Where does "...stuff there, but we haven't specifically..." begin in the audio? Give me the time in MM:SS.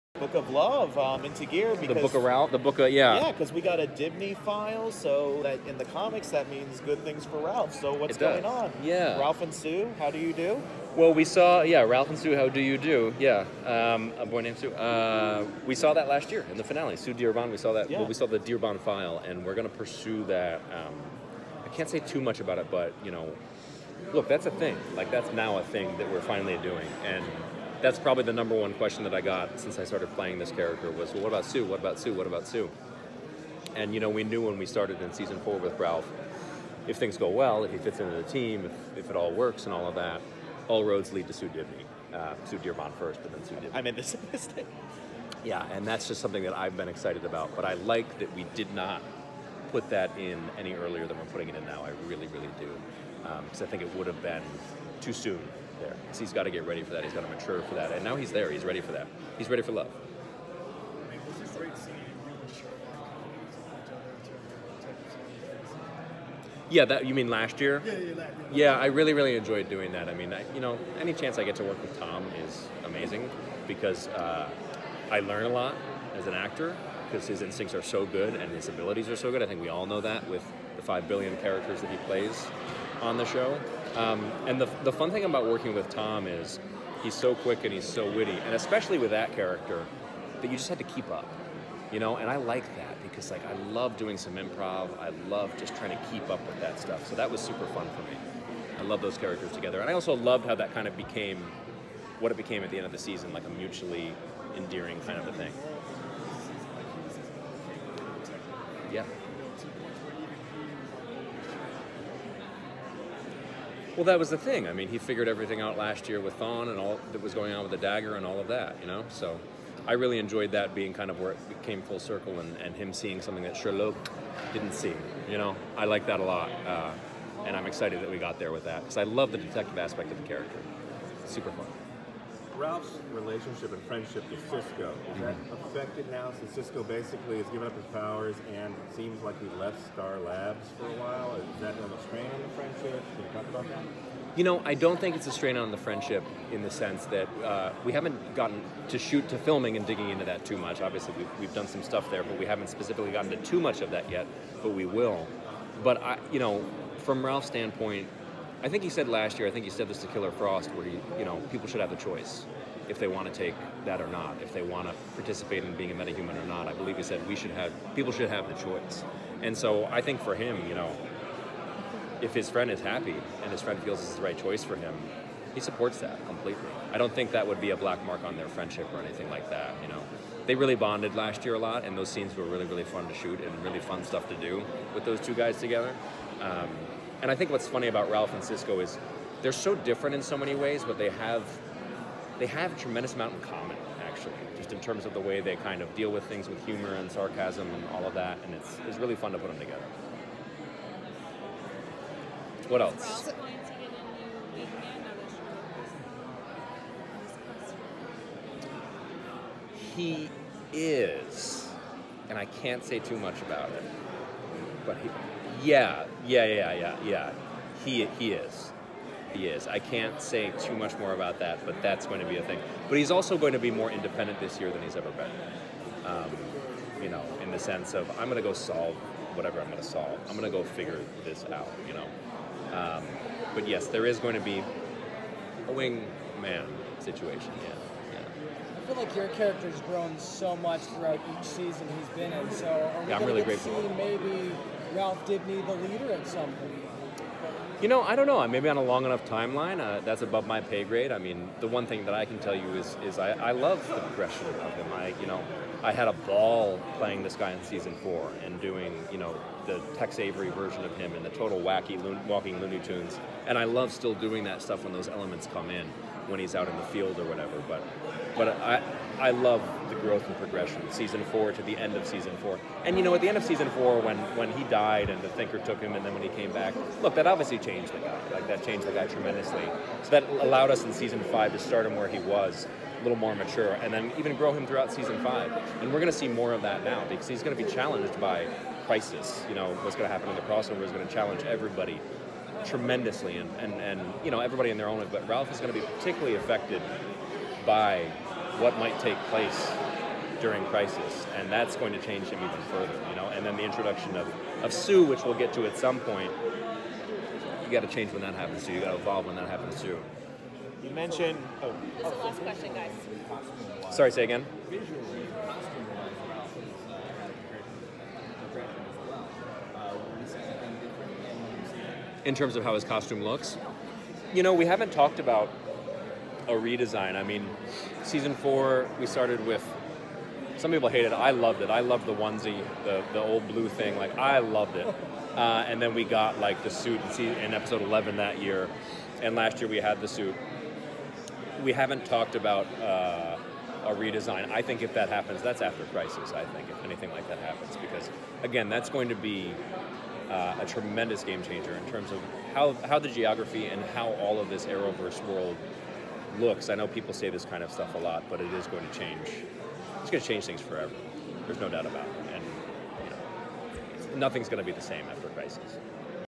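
02:31.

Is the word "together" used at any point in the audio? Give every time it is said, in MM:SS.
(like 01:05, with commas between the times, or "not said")
01:39, 03:05, 03:19.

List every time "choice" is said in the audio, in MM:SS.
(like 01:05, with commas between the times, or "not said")
02:41, 02:48, 02:54.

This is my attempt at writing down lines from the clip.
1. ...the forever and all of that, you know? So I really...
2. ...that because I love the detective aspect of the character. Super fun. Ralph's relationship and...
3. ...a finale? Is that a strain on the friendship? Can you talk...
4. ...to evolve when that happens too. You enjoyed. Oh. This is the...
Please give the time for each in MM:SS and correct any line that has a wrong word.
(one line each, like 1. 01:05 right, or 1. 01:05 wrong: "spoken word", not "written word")
1. 01:57 wrong: "dagger", not "forever"
2. 02:08 right
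3. 02:20 wrong: "while", not "finale"
4. 05:08 wrong: "mentioned", not "enjoyed".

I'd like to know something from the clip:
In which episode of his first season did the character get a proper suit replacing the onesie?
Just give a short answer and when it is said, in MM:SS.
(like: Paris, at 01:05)
Episode 11, at 05:37.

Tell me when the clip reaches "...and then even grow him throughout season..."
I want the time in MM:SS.
04:43.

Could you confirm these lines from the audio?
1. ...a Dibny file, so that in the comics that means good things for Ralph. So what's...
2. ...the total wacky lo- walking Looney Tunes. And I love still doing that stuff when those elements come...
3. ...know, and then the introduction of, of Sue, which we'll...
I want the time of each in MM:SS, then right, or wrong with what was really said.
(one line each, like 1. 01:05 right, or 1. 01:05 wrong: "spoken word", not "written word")
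1. 00:03 right
2. 04:21 right
3. 05:03 right.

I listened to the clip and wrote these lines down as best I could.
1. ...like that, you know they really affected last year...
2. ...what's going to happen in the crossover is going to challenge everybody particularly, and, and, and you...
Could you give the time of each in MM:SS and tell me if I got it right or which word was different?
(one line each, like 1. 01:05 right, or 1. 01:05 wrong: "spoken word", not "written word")
1. 02:59 wrong: "bonded", not "affected"
2. 04:49 wrong: "tremendously", not "particularly".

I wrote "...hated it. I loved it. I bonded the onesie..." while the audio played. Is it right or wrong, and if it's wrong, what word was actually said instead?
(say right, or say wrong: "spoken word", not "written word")
wrong: "loved", not "bonded".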